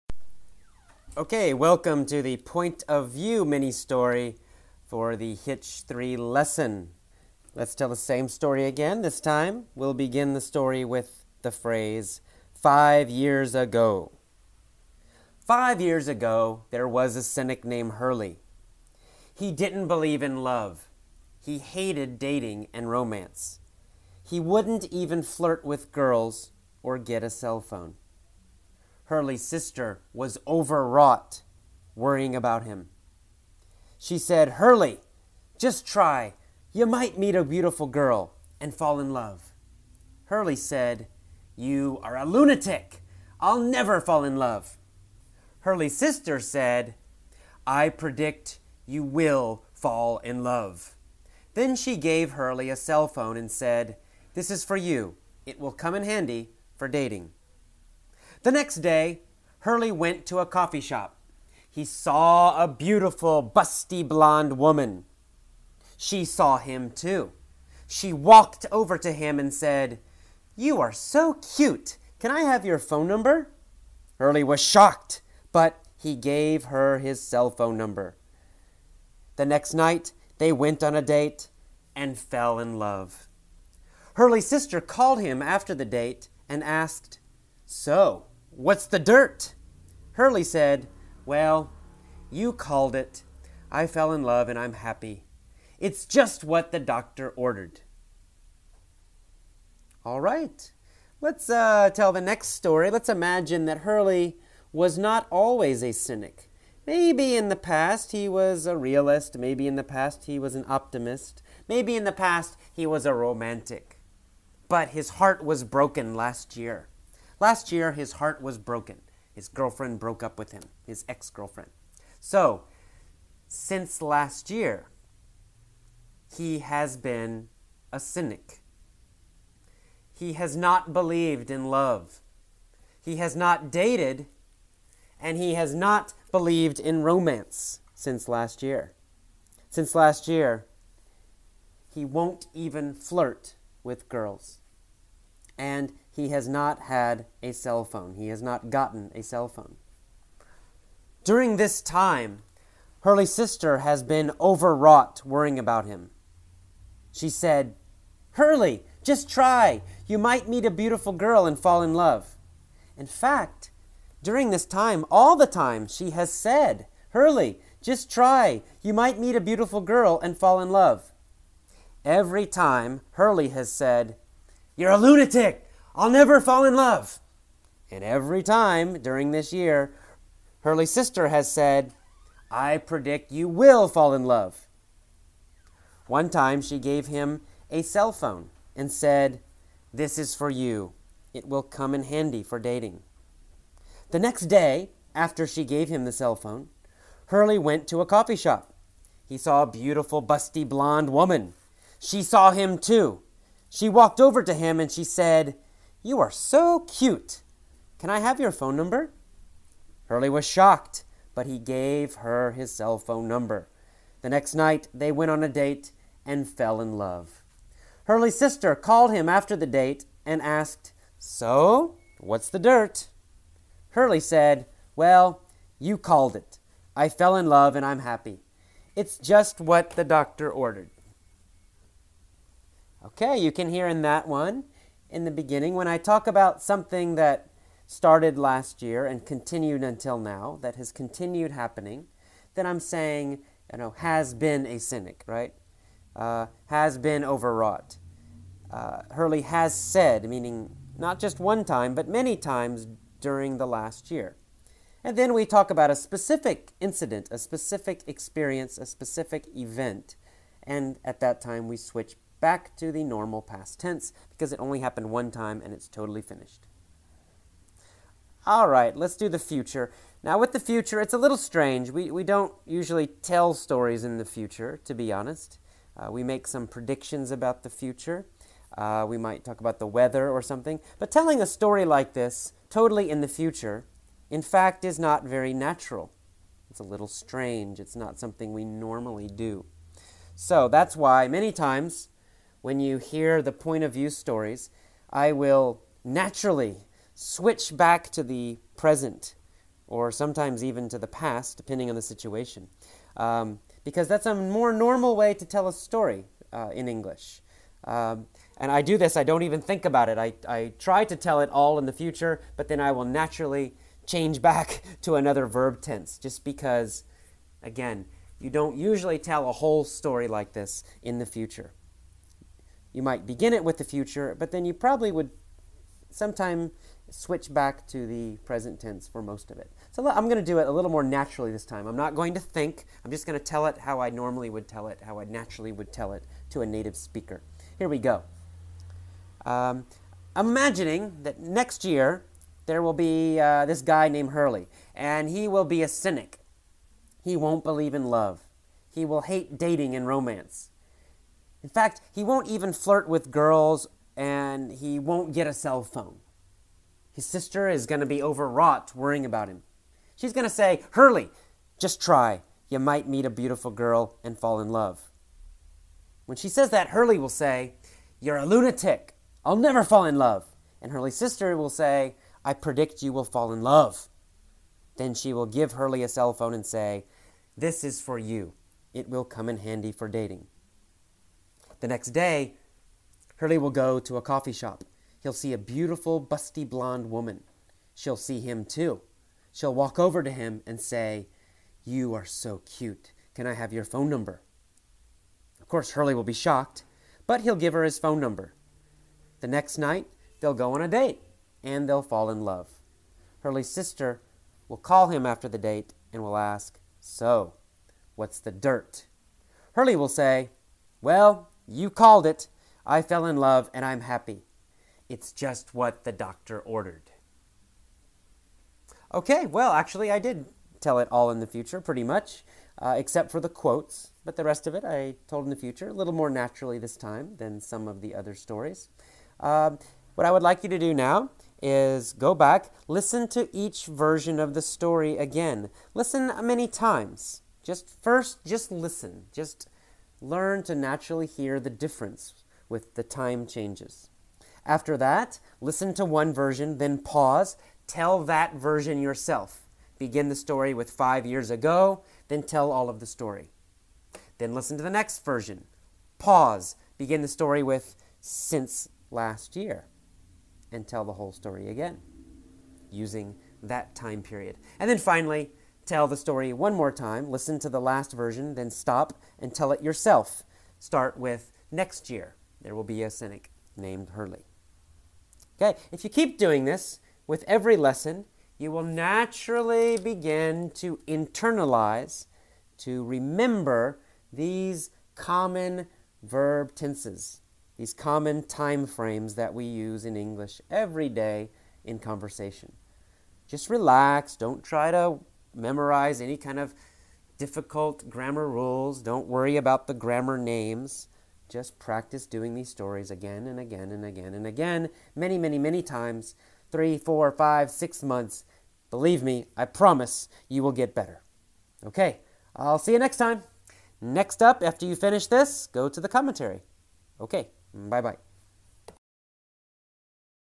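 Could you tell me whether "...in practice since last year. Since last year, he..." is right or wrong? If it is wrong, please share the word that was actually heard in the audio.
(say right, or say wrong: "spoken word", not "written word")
wrong: "romance", not "practice".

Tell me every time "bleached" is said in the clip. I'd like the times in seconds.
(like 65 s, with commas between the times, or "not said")
not said.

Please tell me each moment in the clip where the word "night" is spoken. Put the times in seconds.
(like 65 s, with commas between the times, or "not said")
79 s, 214 s, 399 s.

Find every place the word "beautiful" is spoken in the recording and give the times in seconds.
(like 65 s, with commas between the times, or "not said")
37 s, 62 s, 160 s, 169 s, 199 s, 363 s, 385 s.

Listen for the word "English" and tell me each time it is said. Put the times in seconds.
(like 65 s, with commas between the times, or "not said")
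306 s, 490 s.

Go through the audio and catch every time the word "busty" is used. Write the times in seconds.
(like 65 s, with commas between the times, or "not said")
63 s, 200 s, 386 s.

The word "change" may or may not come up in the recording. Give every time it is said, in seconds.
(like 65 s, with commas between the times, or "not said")
314 s, 443 s.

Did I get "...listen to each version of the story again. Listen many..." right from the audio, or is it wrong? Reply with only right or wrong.
right.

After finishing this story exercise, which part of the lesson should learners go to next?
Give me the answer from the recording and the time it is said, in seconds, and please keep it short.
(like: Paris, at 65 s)
the commentary, at 515 s.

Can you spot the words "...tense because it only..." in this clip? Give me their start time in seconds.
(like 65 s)
263 s.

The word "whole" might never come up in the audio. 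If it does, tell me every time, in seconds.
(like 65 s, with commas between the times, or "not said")
319 s, 461 s.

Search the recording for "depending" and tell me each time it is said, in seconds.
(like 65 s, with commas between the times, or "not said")
301 s.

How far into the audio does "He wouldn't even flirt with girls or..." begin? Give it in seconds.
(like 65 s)
24 s.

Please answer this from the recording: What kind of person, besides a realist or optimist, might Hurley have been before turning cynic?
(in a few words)
a romantic.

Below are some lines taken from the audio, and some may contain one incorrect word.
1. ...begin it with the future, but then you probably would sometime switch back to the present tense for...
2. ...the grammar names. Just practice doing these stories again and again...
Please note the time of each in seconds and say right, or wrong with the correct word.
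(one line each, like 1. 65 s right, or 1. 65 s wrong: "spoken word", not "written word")
1. 323 s right
2. 499 s right.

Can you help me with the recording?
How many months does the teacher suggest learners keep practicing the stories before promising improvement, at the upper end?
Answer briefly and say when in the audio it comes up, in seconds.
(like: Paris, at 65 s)
6, at 507 s.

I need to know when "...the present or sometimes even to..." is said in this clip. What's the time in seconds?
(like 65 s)
298 s.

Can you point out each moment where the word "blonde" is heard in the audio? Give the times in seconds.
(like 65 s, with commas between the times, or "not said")
64 s, 200 s, 386 s.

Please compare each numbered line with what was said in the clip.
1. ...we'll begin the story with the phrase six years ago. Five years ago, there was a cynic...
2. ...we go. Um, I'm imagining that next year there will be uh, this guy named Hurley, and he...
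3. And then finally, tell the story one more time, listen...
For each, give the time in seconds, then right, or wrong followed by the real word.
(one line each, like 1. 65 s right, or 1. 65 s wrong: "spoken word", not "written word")
1. 9 s wrong: "five", not "six"
2. 337 s right
3. 464 s right.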